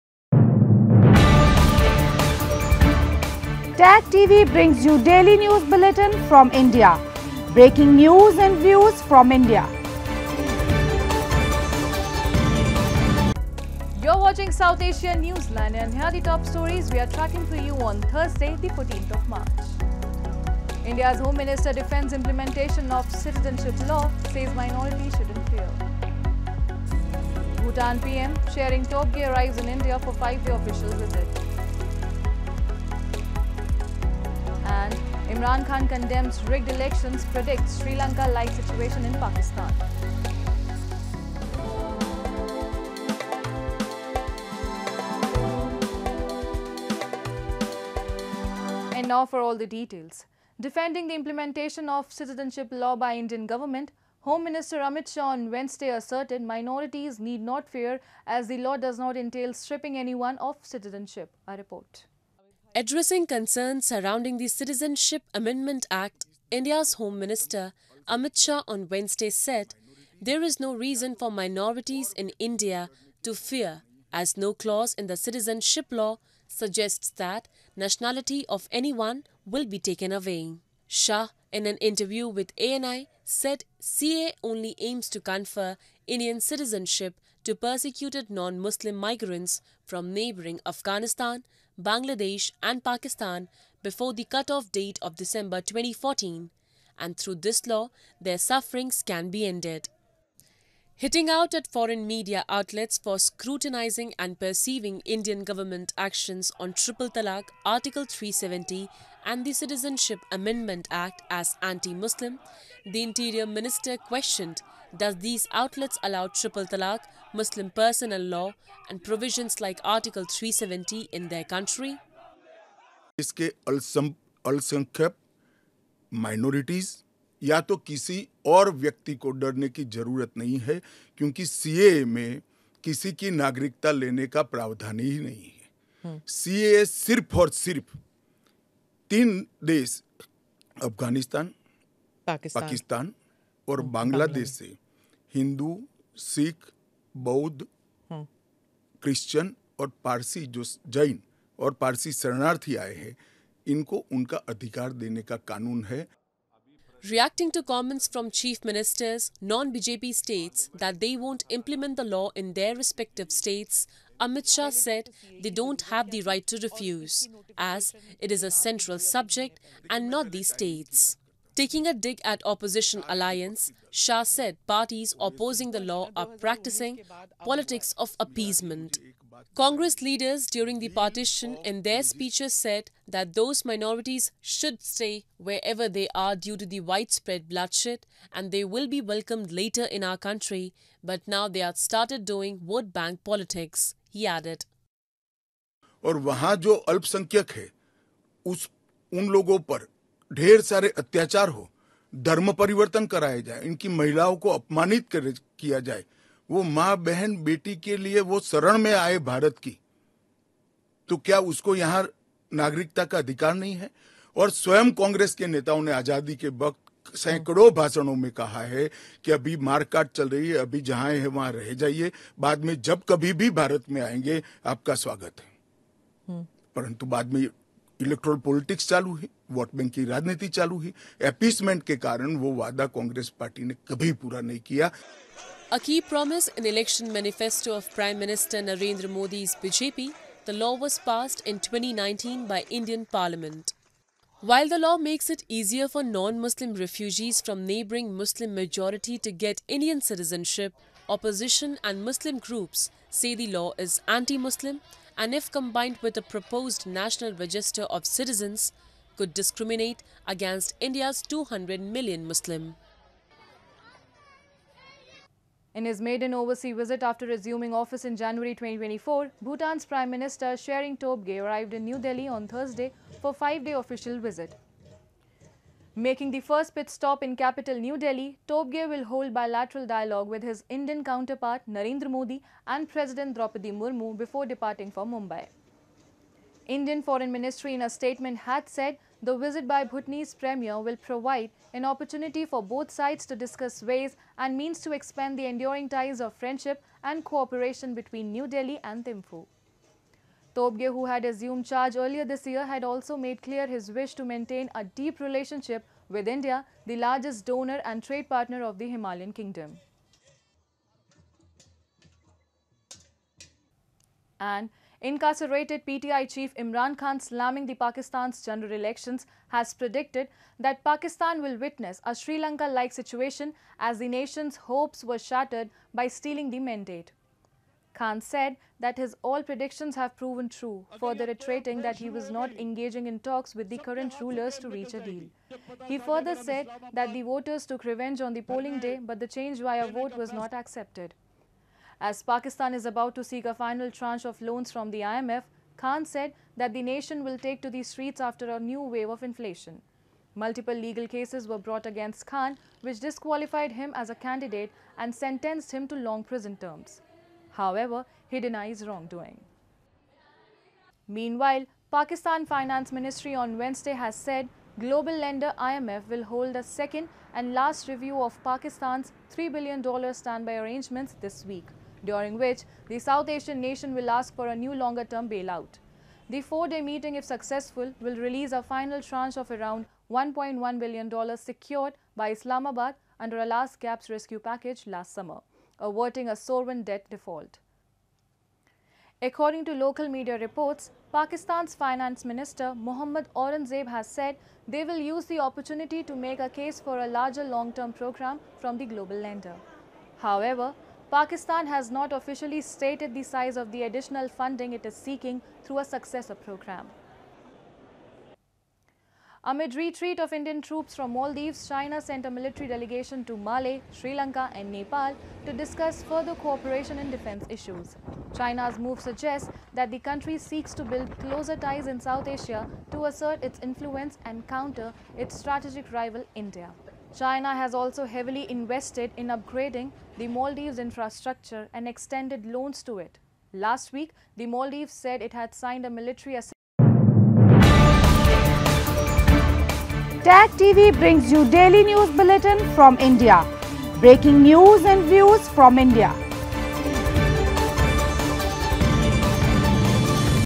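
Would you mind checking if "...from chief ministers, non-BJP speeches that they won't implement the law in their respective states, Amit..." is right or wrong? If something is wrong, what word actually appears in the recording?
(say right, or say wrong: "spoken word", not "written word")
wrong: "states", not "speeches".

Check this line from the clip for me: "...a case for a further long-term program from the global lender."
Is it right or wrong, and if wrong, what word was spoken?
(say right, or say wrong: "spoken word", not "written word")
wrong: "larger", not "further".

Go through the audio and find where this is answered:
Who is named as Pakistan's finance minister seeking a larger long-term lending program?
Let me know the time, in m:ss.
6:32.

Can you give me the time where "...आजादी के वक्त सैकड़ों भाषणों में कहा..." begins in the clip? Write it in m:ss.
3:35.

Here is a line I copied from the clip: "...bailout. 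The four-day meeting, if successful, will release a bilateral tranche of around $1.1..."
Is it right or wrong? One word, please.
wrong.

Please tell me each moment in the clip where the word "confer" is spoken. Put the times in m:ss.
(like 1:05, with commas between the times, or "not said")
1:25.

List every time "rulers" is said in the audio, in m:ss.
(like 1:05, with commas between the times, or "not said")
5:34.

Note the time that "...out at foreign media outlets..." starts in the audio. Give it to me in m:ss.
1:41.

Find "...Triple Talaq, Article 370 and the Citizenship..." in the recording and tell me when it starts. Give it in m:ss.
1:46.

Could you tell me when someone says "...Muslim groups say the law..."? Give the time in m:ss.
4:12.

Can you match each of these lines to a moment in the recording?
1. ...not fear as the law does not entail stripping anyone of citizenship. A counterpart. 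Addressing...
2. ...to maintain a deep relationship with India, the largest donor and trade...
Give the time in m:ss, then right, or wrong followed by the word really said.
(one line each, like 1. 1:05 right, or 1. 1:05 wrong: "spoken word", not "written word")
1. 0:57 wrong: "report", not "counterpart"
2. 5:04 right.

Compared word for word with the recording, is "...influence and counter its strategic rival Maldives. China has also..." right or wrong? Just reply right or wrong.
wrong.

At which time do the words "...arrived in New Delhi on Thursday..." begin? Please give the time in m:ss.
4:31.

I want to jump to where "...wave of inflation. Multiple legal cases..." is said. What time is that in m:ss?
5:48.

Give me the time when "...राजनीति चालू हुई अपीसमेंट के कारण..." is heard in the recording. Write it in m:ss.
3:50.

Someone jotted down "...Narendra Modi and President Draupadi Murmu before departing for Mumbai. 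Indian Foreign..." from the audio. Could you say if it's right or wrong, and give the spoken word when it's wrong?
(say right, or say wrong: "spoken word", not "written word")
right.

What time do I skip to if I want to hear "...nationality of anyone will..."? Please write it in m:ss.
1:17.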